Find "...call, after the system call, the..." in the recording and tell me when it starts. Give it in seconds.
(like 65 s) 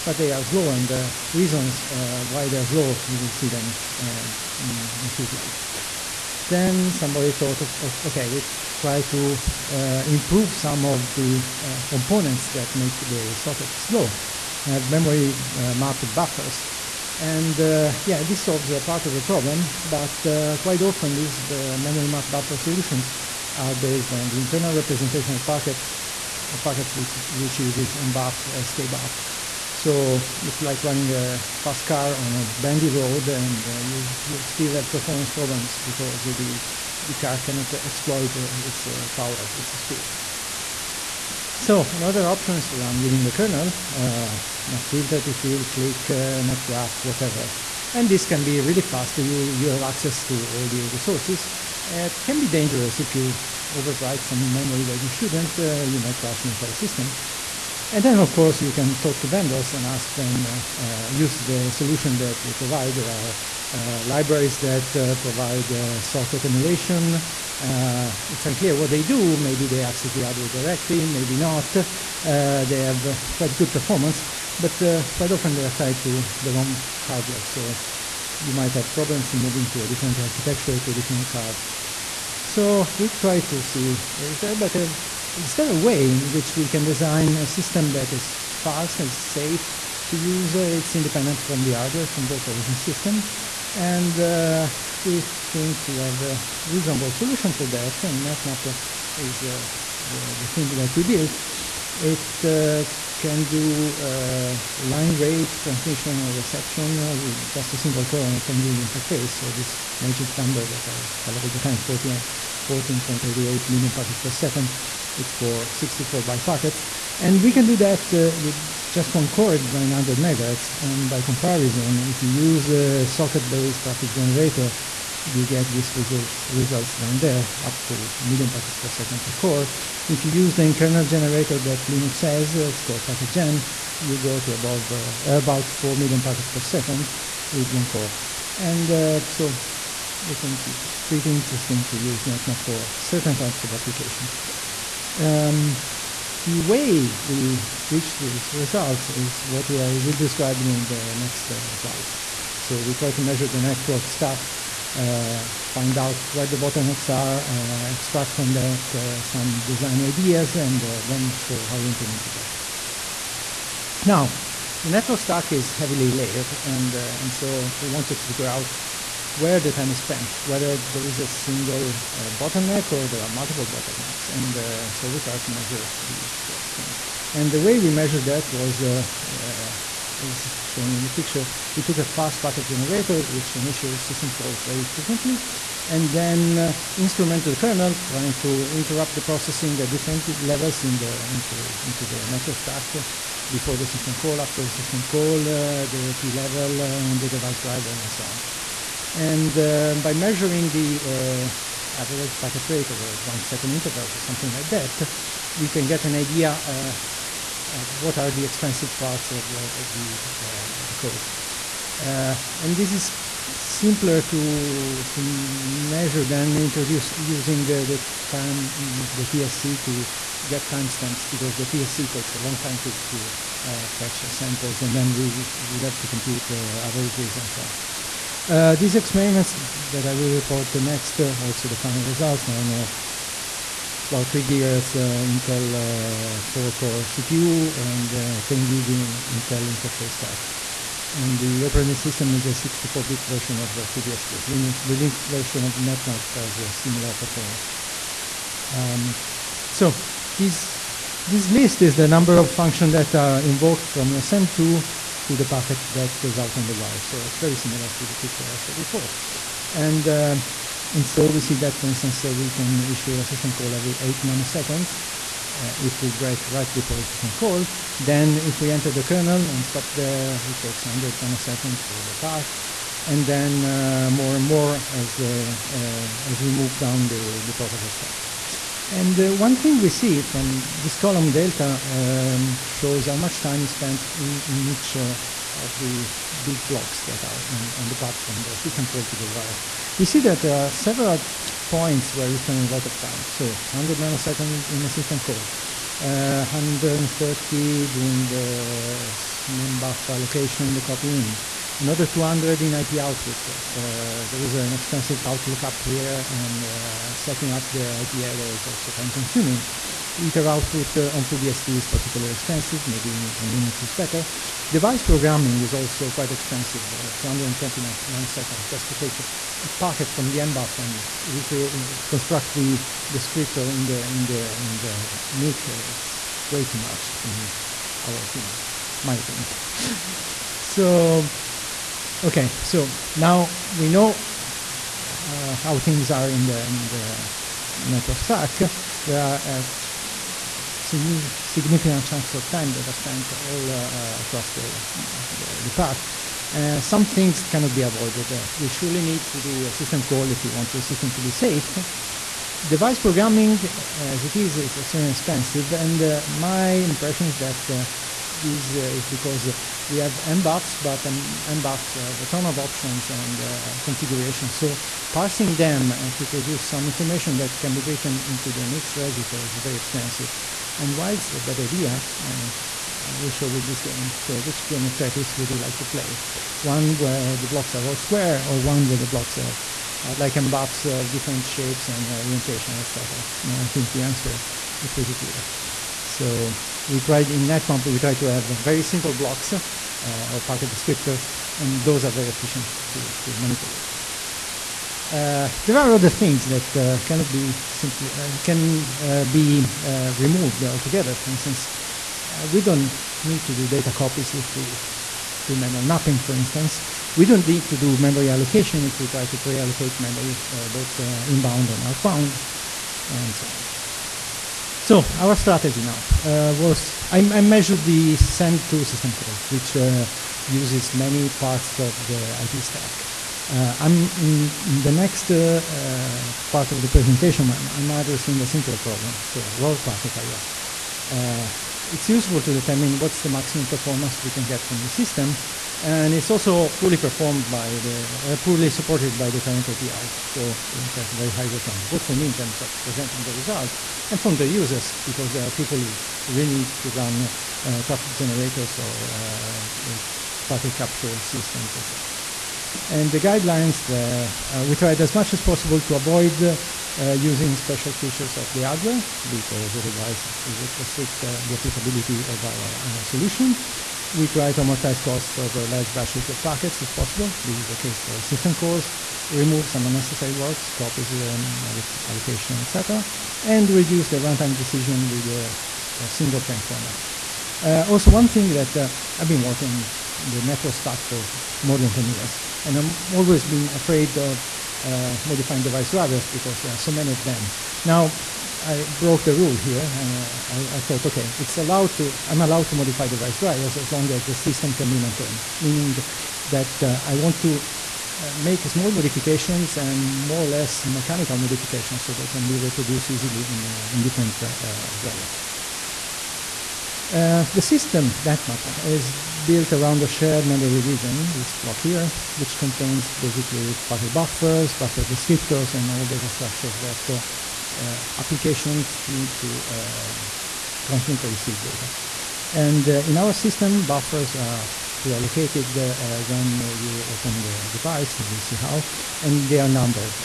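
194 s.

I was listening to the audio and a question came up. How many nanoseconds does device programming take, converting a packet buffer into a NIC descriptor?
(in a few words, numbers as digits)
220.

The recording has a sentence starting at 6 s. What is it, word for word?
Then somebody thought, okay, we try to uh, improve some of the uh, components that make the socket slow.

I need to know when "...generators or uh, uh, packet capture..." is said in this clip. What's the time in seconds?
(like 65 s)
448 s.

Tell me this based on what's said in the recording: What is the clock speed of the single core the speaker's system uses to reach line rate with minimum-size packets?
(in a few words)
900 megahertz.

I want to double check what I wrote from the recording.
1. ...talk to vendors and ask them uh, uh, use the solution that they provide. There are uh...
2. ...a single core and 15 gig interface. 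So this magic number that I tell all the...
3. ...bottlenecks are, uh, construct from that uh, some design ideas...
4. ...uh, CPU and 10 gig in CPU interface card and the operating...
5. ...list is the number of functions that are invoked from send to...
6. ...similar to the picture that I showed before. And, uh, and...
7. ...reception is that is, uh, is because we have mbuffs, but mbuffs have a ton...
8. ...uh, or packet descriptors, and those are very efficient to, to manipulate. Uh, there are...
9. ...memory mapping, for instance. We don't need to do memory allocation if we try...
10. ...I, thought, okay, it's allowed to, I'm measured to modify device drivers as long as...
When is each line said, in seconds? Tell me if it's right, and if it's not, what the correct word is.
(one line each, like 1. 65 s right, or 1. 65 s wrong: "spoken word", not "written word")
1. 59 s right
2. 107 s wrong: "10", not "15"
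3. 156 s wrong: "extract", not "construct"
4. 237 s wrong: "Intel", not "CPU"
5. 251 s right
6. 257 s right
7. 356 s wrong: "impression", not "reception"
8. 389 s right
9. 405 s right
10. 490 s wrong: "allowed", not "measured".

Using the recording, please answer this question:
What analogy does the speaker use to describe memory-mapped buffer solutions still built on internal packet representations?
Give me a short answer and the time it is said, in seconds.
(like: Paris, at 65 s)
a fast car on a bendy road, at 31 s.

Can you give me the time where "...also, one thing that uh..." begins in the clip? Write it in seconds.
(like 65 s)
477 s.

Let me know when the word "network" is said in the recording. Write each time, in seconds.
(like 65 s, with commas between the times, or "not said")
153 s, 164 s, 192 s, 337 s, 480 s.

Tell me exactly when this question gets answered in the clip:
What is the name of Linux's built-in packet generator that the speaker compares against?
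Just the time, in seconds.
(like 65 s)
133 s.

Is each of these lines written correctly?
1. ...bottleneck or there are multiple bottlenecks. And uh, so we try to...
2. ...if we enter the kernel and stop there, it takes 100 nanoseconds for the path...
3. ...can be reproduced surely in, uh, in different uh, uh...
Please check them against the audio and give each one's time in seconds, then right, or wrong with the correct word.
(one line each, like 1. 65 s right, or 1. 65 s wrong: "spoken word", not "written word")
1. 172 s right
2. 268 s right
3. 502 s wrong: "easily", not "surely".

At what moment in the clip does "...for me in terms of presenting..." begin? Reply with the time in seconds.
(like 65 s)
442 s.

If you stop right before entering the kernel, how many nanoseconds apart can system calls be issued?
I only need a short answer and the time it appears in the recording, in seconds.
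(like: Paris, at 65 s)
8 nanoseconds, at 263 s.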